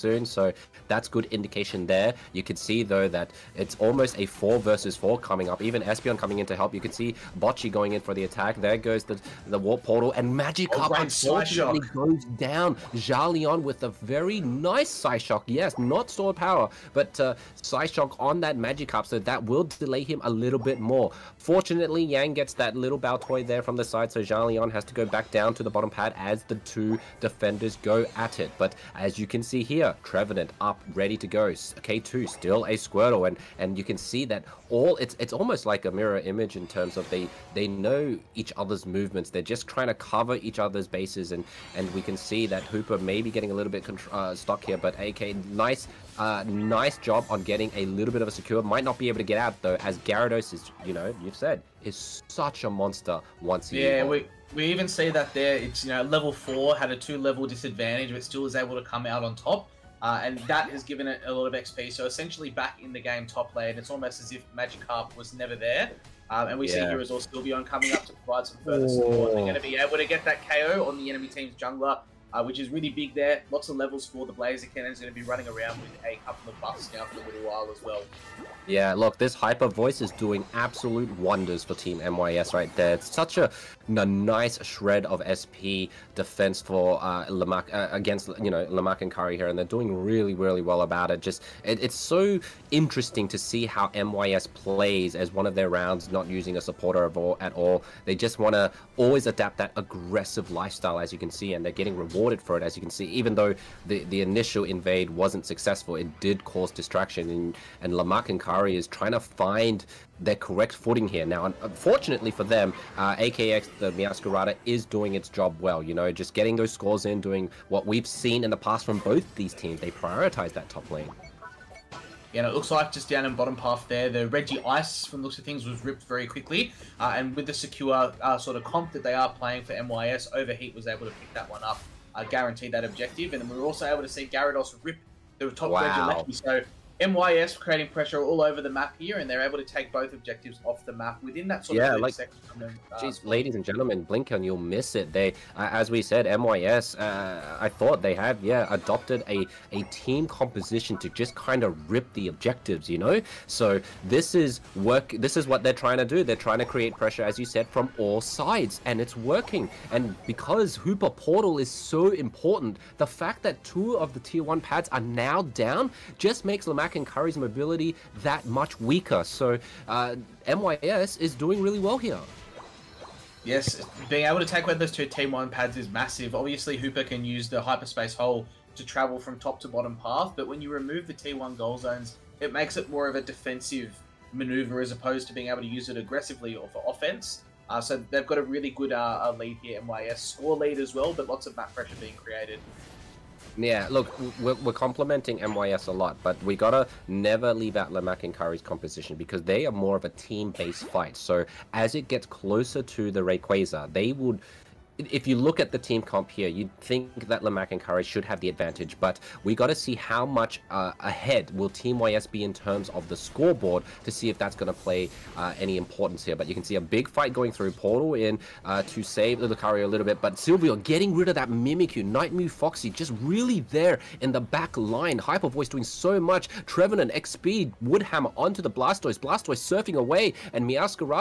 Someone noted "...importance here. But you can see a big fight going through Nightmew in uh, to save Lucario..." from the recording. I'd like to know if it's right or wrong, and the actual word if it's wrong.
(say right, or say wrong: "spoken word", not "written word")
wrong: "Portal", not "Nightmew".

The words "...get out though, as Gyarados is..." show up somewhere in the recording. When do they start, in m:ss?
0:49.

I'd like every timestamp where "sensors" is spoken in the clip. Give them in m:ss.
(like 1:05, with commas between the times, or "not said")
not said.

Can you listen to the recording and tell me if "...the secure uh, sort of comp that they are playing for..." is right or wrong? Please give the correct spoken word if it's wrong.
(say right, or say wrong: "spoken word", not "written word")
right.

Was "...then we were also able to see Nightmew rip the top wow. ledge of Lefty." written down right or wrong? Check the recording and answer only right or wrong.
wrong.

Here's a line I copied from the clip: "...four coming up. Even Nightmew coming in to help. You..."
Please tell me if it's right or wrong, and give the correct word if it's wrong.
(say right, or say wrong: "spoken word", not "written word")
wrong: "Espeon", not "Nightmew".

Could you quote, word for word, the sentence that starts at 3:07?
Uh, so they've got a really good uh, lead here, MYS.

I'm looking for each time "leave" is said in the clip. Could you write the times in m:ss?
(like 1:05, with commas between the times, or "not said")
3:17.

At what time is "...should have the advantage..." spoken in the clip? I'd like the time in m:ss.
3:28.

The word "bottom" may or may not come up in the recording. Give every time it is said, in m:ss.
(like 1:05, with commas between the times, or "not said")
0:25, 2:03, 2:59.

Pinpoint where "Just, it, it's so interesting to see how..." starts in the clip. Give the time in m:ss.
1:31.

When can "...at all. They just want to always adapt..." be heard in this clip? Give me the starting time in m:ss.
1:37.